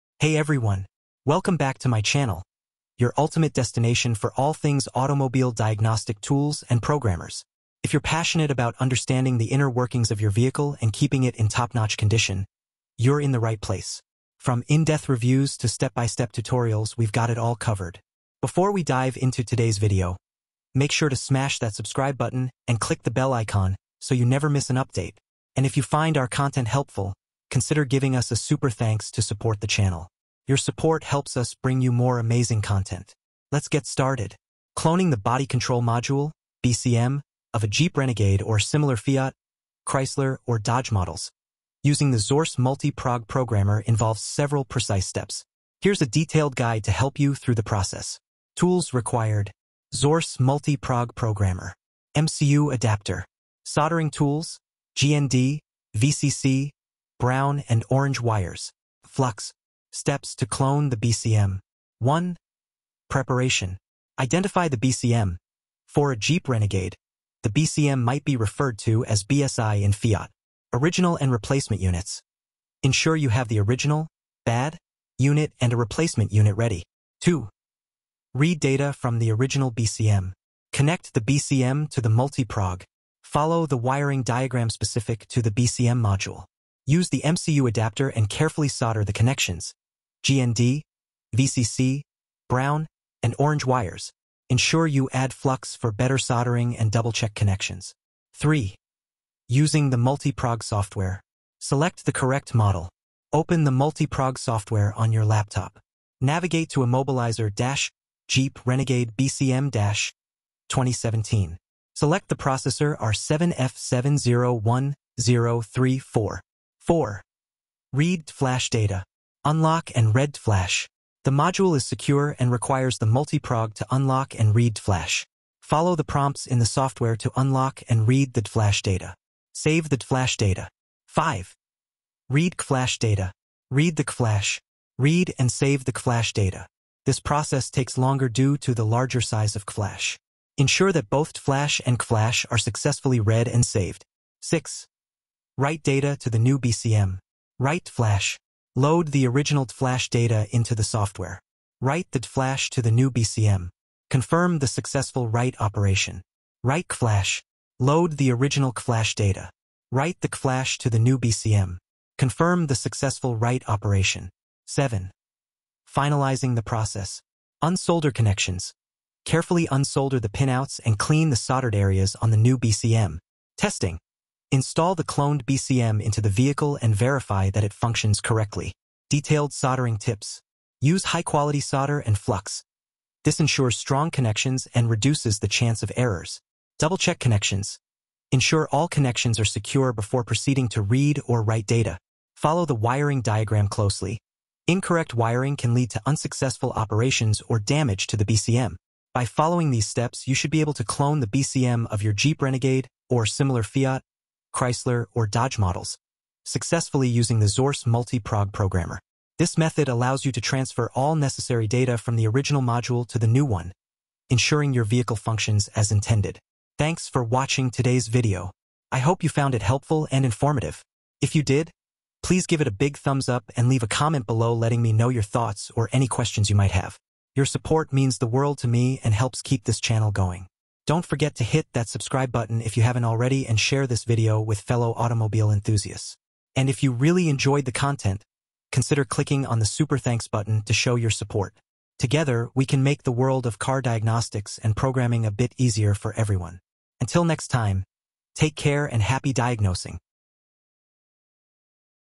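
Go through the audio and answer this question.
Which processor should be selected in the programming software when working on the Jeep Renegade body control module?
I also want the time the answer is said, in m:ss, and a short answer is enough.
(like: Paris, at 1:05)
R7F701034, at 1:52.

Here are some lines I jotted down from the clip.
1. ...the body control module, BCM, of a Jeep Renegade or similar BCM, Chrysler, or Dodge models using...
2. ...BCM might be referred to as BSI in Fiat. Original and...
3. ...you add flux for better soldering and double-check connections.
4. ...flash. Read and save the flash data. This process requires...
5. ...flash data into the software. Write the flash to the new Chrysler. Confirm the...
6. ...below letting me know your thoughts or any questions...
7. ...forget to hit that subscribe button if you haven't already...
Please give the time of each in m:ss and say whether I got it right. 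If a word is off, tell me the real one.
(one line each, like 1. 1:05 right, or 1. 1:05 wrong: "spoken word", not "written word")
1. 0:35 wrong: "Fiat", not "BCM"
2. 1:07 right
3. 1:34 right
4. 2:14 wrong: "takes", not "requires"
5. 2:29 wrong: "BCM", not "Chrysler"
6. 3:44 right
7. 3:51 right.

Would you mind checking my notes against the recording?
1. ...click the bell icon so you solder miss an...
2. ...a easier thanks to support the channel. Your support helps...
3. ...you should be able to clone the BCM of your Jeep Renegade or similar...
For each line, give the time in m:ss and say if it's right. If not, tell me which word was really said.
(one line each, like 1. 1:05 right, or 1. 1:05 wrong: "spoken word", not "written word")
1. 0:22 wrong: "never", not "solder"
2. 0:28 wrong: "super", not "easier"
3. 3:20 right.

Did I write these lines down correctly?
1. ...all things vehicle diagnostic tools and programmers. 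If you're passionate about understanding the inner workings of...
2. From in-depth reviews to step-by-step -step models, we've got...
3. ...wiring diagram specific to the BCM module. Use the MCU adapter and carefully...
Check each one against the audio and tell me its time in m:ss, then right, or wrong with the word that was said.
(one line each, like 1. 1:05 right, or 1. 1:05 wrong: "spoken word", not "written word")
1. 0:04 wrong: "automobile", not "vehicle"
2. 0:14 wrong: "tutorials", not "models"
3. 1:23 right.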